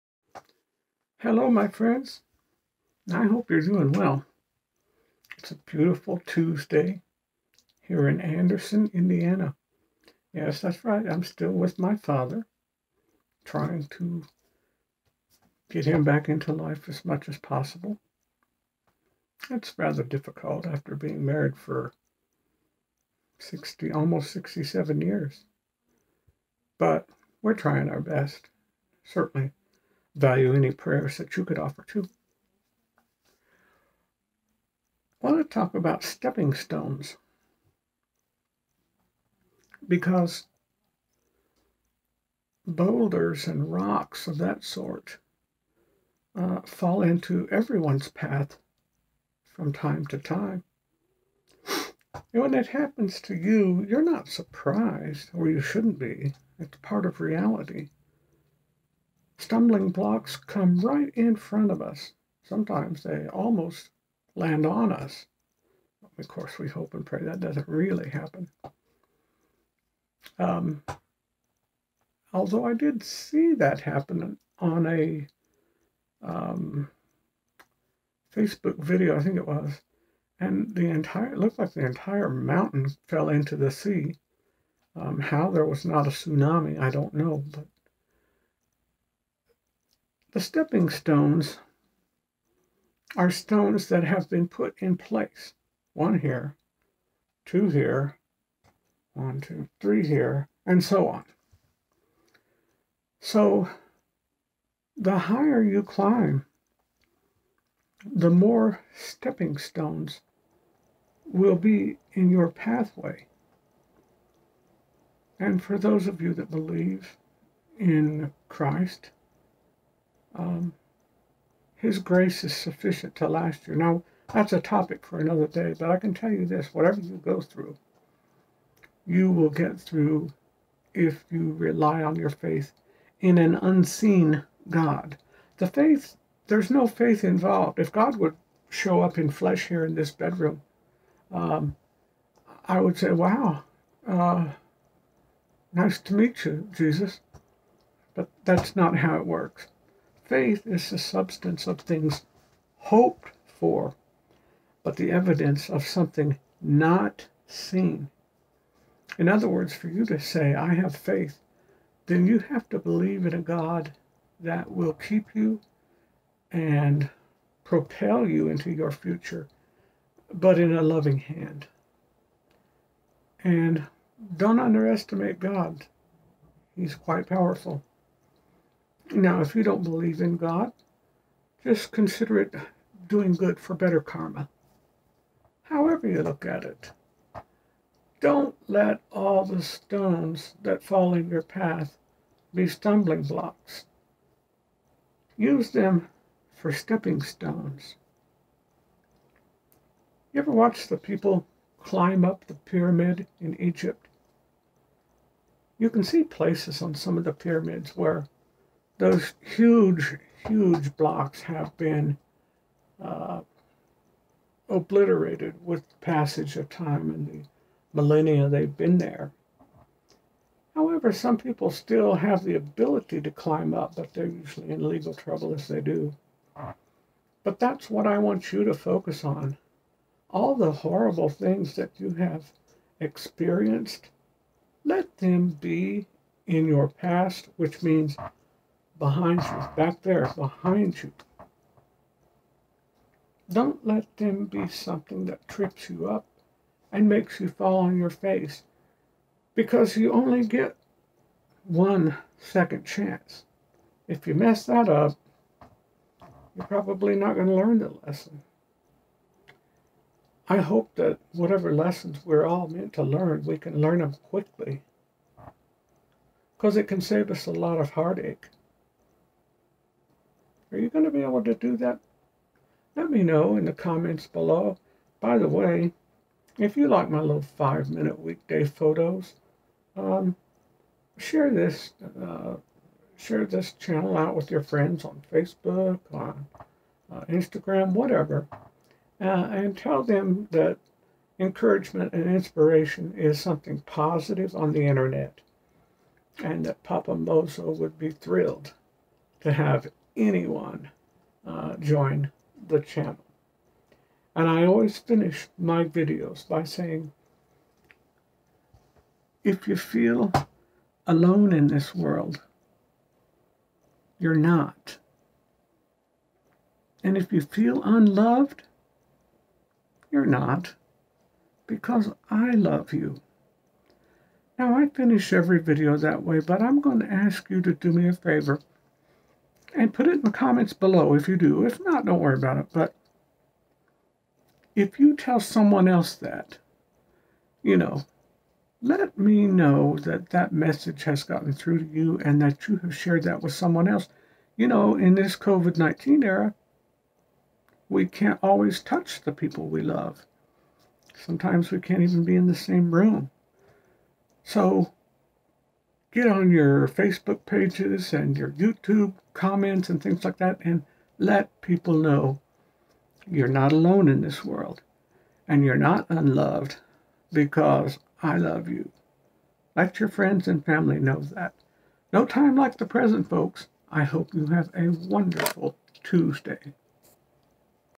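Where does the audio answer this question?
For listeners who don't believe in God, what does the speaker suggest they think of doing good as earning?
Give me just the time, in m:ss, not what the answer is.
3:03.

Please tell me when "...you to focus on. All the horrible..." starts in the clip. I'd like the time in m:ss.
3:48.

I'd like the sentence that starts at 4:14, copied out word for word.
If you mess that up, you're probably not going to learn the lesson.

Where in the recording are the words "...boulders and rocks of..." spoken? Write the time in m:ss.
0:42.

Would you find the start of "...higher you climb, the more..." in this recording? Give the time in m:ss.
1:45.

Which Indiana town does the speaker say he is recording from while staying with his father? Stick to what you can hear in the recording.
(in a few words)
Anderson.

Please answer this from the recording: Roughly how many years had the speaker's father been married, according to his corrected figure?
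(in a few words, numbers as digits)
67.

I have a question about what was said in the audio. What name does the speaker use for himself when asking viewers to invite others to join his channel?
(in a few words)
Papa Mozo.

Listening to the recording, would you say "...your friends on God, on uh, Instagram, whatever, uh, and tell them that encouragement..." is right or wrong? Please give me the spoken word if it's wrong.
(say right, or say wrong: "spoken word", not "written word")
wrong: "Facebook", not "God".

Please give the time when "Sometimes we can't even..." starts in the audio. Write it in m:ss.
5:51.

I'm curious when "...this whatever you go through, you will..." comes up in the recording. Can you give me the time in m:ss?
2:06.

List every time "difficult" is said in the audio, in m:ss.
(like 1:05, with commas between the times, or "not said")
0:20.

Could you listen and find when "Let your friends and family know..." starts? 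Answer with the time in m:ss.
6:09.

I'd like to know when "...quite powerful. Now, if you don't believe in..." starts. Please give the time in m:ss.
2:56.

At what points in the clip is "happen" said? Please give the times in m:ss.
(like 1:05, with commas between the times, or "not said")
0:52, 1:08, 1:13.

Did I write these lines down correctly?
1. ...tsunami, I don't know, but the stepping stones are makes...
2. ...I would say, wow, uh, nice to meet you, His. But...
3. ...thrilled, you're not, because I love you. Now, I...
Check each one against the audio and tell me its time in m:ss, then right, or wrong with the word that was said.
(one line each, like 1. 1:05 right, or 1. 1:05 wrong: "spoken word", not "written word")
1. 1:26 wrong: "stones", not "makes"
2. 2:22 wrong: "Jesus", not "His"
3. 5:17 wrong: "unloved", not "thrilled".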